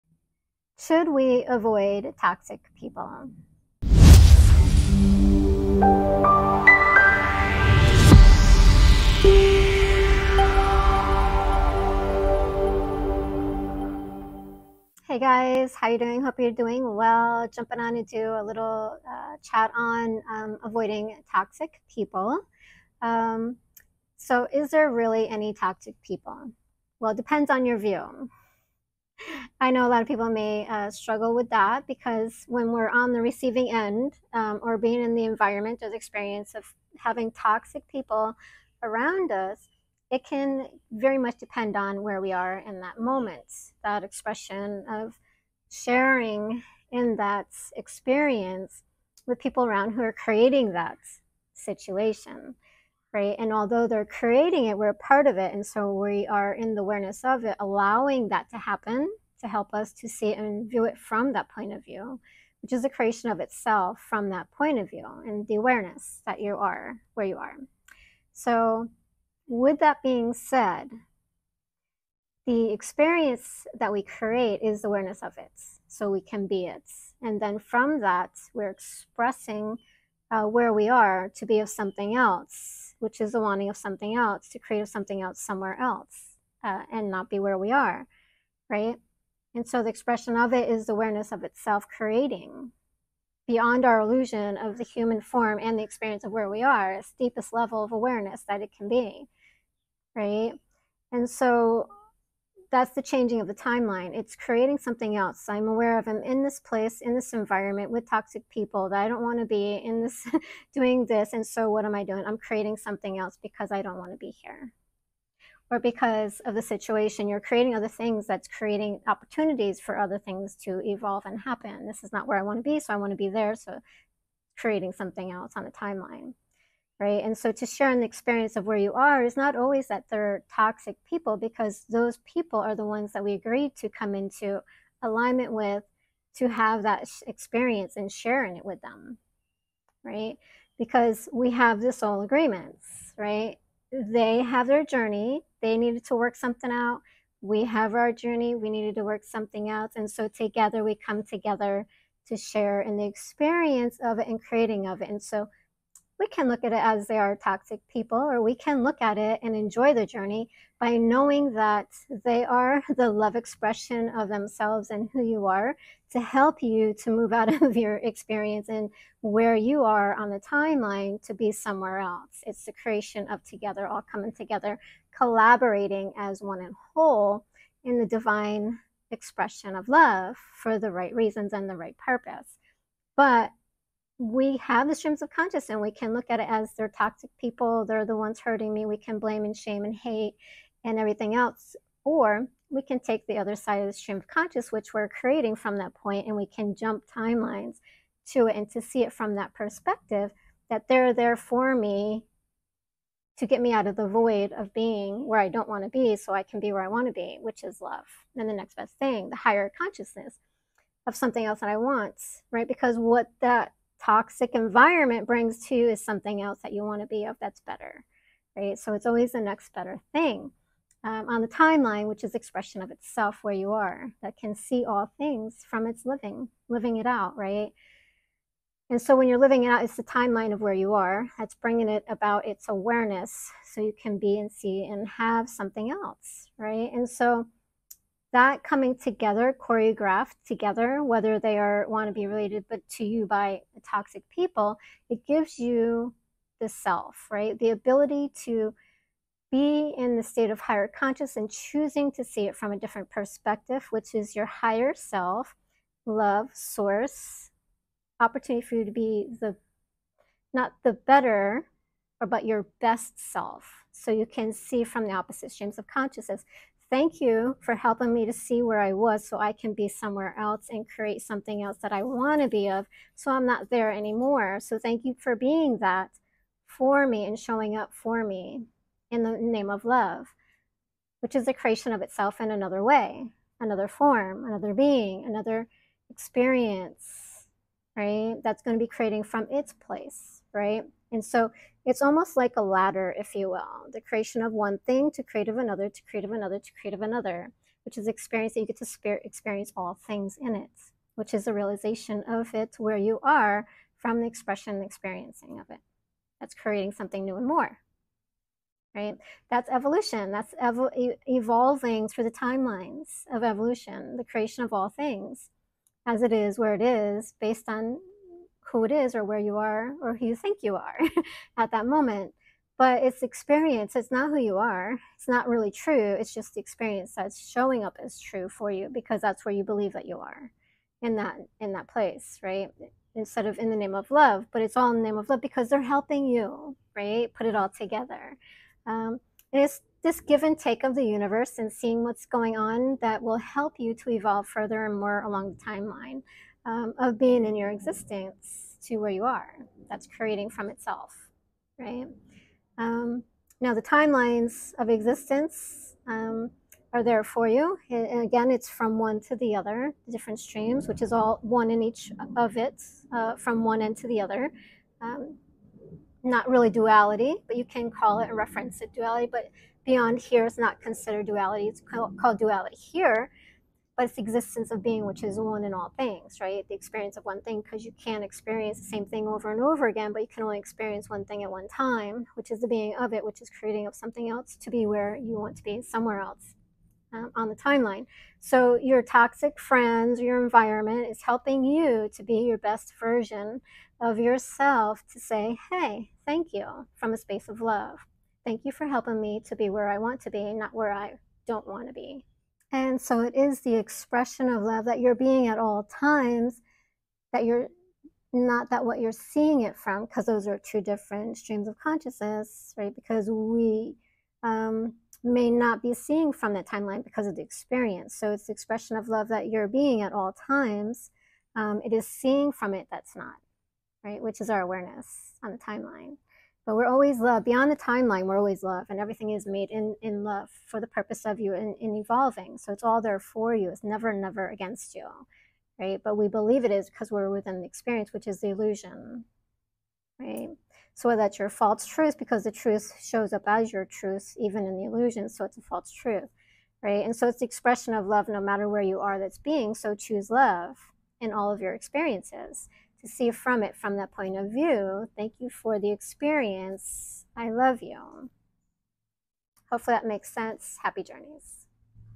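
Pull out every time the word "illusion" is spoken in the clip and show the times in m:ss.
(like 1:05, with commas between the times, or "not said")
1:33, 7:18, 7:24.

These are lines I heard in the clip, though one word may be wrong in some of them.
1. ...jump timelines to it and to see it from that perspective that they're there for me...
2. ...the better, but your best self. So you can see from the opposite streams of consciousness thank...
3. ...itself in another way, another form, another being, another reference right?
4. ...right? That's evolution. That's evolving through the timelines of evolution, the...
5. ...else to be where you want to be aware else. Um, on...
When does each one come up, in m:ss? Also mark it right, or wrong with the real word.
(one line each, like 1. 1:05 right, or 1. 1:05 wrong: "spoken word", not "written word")
1. 3:16 right
2. 4:20 right
3. 4:42 wrong: "experience", not "reference"
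4. 5:08 right
5. 6:24 wrong: "somewhere", not "aware".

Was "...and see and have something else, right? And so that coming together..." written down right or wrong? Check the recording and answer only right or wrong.
right.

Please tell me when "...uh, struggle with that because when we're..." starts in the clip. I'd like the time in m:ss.
0:30.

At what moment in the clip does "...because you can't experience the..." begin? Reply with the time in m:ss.
6:17.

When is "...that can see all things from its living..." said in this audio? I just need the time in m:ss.
3:44.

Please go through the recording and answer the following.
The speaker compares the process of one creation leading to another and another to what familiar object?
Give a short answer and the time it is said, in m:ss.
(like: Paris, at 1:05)
a ladder, at 4:52.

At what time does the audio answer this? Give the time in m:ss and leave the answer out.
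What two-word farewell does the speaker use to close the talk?
7:40.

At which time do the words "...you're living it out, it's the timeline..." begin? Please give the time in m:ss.
3:49.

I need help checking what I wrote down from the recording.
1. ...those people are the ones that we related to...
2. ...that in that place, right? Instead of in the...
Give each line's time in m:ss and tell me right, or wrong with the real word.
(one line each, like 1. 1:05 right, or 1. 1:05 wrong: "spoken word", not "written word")
1. 2:11 wrong: "agreed", not "related"
2. 5:31 right.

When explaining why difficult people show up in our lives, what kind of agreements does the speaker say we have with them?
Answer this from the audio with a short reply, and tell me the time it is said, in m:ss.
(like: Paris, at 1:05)
soul agreements, at 2:21.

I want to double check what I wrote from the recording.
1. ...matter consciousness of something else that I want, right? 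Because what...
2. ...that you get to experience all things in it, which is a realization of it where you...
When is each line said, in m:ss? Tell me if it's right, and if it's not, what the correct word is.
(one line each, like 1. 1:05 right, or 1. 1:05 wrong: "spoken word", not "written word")
1. 3:29 wrong: "higher", not "matter"
2. 4:58 right.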